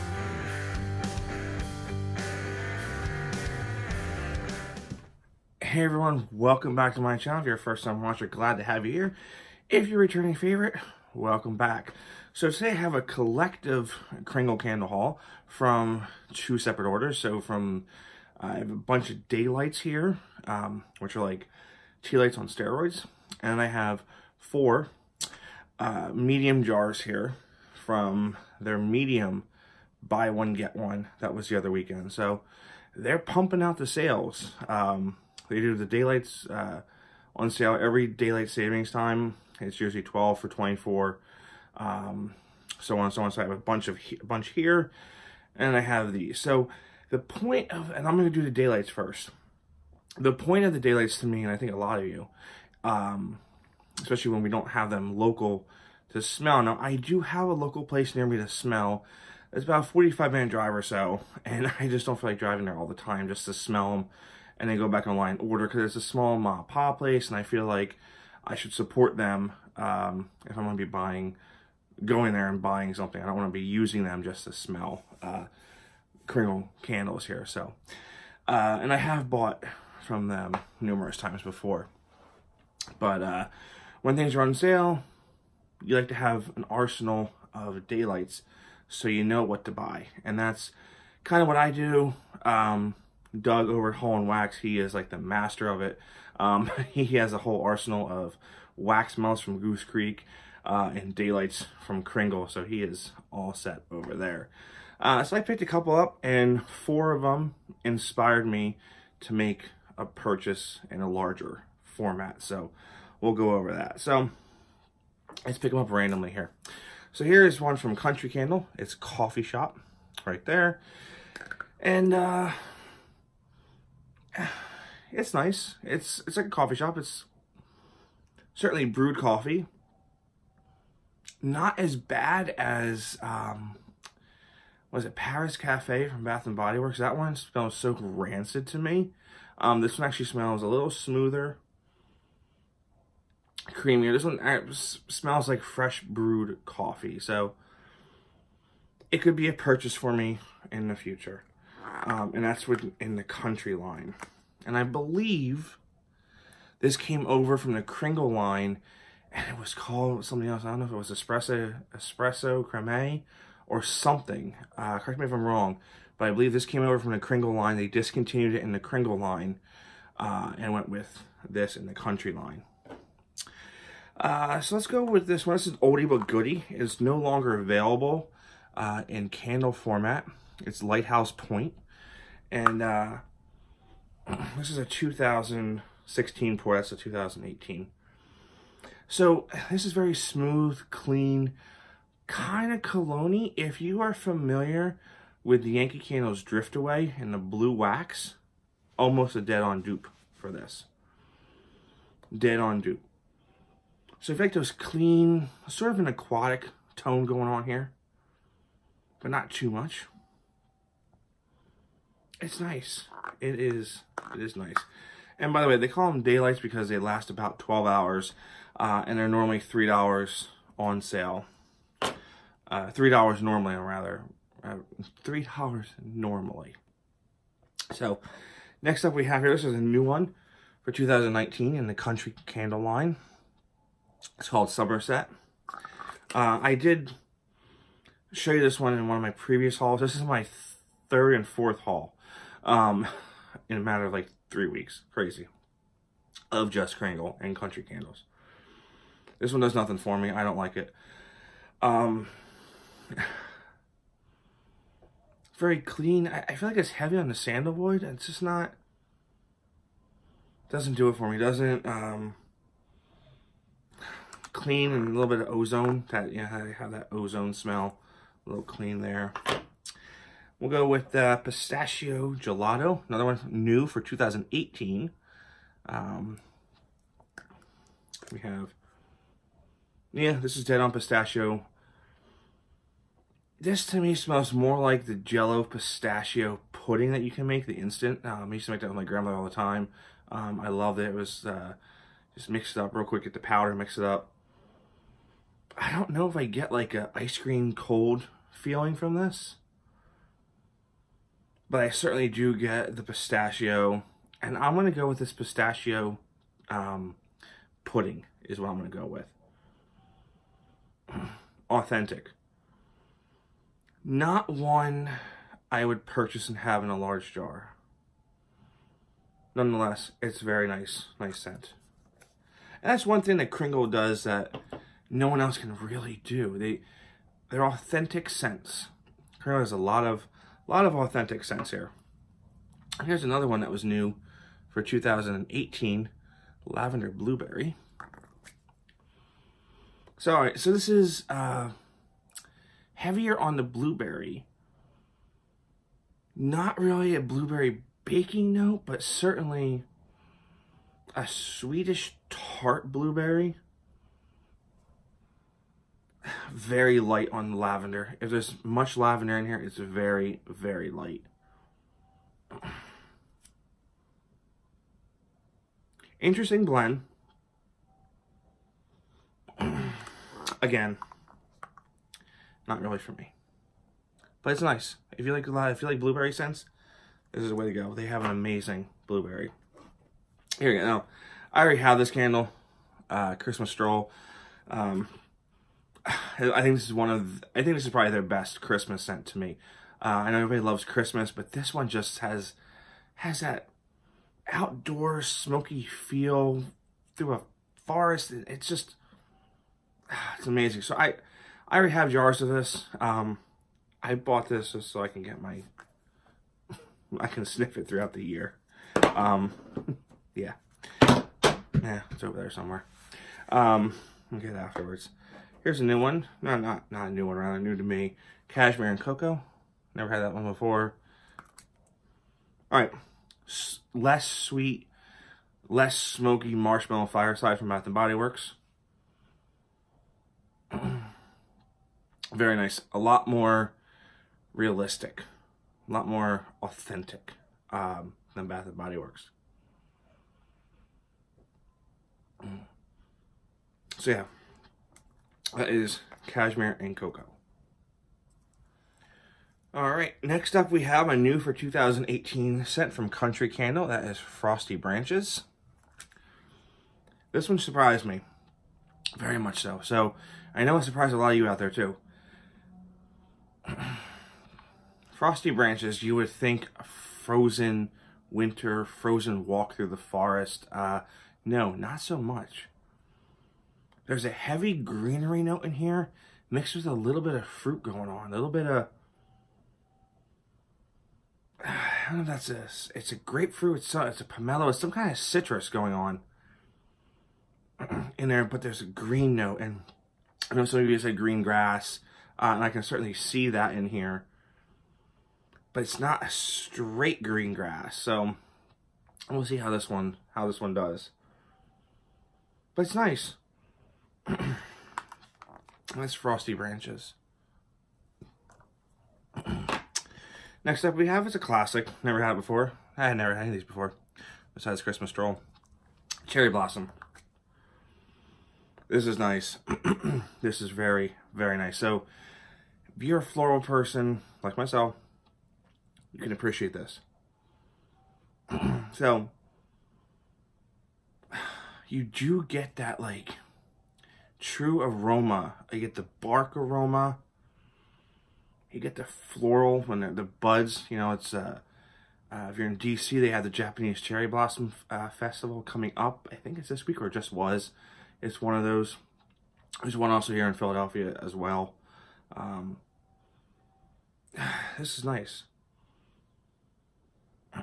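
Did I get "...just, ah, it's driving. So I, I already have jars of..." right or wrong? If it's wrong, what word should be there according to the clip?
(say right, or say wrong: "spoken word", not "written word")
wrong: "amazing", not "driving".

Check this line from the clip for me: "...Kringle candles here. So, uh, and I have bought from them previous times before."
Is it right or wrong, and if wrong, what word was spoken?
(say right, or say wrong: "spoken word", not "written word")
wrong: "numerous", not "previous".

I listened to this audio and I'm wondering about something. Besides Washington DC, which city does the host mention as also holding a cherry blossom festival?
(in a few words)
Philadelphia.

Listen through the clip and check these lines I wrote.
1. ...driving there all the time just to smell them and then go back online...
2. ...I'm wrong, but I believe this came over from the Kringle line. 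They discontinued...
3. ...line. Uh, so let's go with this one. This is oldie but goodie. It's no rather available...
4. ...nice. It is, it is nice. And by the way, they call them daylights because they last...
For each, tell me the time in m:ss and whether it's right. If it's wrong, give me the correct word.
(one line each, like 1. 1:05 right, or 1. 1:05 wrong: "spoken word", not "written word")
1. 1:02 right
2. 2:45 right
3. 2:52 wrong: "longer", not "rather"
4. 3:32 right.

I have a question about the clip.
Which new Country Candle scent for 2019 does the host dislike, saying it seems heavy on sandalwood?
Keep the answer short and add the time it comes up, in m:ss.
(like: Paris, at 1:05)
Somerset, at 3:54.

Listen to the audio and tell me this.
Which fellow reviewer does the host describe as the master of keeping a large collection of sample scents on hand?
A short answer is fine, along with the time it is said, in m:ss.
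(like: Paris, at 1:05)
Doug, at 1:33.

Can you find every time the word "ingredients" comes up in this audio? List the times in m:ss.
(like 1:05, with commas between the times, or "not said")
not said.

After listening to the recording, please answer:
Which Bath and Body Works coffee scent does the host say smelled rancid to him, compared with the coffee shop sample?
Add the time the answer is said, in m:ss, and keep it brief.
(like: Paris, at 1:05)
Paris Cafe, at 2:15.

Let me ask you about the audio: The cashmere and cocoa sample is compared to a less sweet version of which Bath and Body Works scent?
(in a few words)
Marshmallow Fireside.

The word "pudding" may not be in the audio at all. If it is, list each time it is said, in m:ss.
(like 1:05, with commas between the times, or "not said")
4:46, 5:07.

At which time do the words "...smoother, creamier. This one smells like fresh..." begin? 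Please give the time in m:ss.
2:20.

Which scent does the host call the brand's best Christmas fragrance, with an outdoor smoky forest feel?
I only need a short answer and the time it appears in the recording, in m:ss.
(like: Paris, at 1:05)
Christmas Stroll, at 6:23.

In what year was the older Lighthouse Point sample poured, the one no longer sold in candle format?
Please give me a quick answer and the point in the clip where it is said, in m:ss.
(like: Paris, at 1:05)
2016, at 3:04.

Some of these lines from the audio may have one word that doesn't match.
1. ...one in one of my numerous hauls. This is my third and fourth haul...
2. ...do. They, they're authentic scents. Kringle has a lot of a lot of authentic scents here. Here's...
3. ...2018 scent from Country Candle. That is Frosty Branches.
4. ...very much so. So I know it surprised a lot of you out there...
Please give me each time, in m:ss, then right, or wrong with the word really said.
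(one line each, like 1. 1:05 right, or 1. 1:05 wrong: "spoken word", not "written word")
1. 3:58 wrong: "previous", not "numerous"
2. 5:26 right
3. 7:31 right
4. 7:39 right.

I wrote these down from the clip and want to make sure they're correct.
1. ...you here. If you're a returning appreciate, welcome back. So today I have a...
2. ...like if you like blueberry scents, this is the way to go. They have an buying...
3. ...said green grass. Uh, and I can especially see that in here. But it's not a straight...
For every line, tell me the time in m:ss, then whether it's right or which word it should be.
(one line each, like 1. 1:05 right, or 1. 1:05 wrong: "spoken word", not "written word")
1. 0:08 wrong: "favorite", not "appreciate"
2. 6:15 wrong: "amazing", not "buying"
3. 8:11 wrong: "certainly", not "especially".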